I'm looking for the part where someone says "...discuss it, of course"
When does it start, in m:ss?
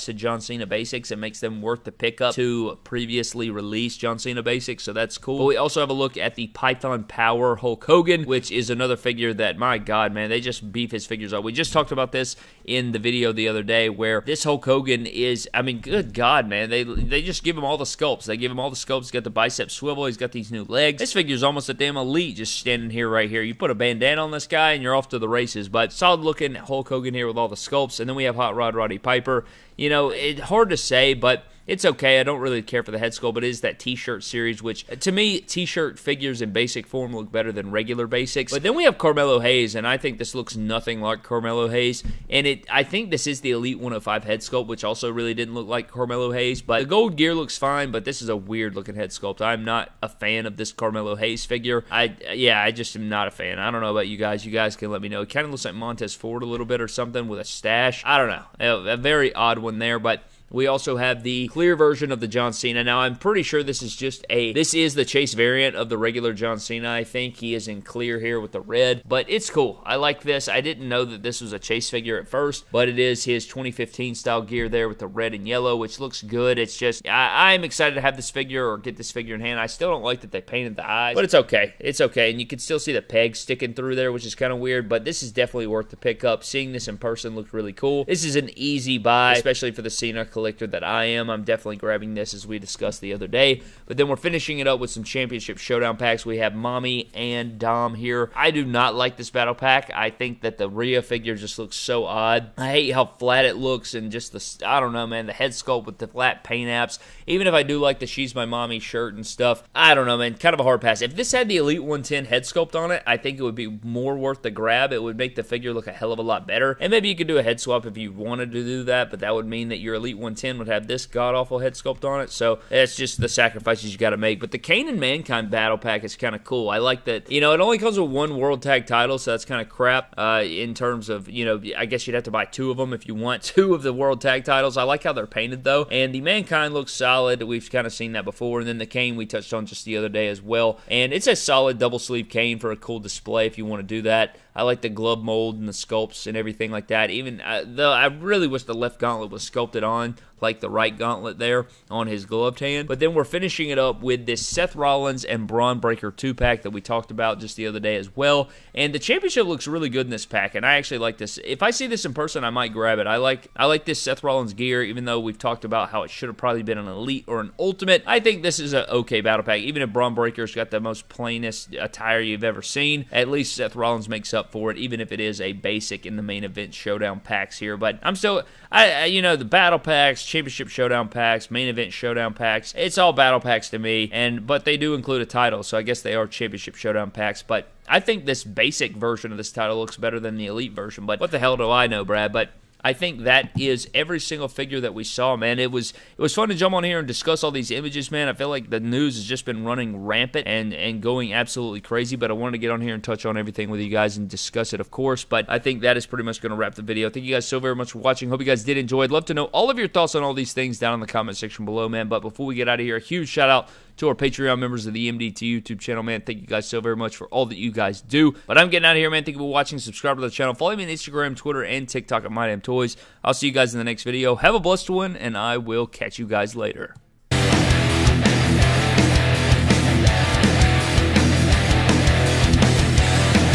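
3:24.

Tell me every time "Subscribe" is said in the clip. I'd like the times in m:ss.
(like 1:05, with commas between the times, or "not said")
3:39.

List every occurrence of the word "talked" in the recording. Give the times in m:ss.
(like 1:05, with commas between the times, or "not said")
0:11, 2:36, 2:45.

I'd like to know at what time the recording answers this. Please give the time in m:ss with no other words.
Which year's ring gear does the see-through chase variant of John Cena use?
1:13.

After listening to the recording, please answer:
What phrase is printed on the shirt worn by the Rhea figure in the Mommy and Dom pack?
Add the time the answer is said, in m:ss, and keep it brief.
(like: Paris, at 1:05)
She's My Mommy, at 1:48.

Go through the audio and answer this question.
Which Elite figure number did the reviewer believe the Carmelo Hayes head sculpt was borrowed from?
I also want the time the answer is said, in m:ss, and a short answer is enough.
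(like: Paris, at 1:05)
Elite 105, at 0:43.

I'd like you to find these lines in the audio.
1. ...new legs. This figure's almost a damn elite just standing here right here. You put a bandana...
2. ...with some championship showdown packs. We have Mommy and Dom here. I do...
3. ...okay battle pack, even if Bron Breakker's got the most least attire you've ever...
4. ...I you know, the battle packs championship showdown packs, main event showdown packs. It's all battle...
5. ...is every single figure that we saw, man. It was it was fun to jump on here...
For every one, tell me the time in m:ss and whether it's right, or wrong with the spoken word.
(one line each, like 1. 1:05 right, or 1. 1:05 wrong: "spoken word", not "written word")
1. 0:20 right
2. 1:34 right
3. 2:48 wrong: "plainest", not "least"
4. 2:58 right
5. 3:13 right.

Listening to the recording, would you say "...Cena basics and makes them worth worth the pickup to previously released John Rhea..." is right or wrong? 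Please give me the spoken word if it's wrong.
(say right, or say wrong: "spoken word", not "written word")
wrong: "Cena", not "Rhea".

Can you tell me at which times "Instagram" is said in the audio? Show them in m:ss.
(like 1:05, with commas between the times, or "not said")
3:40.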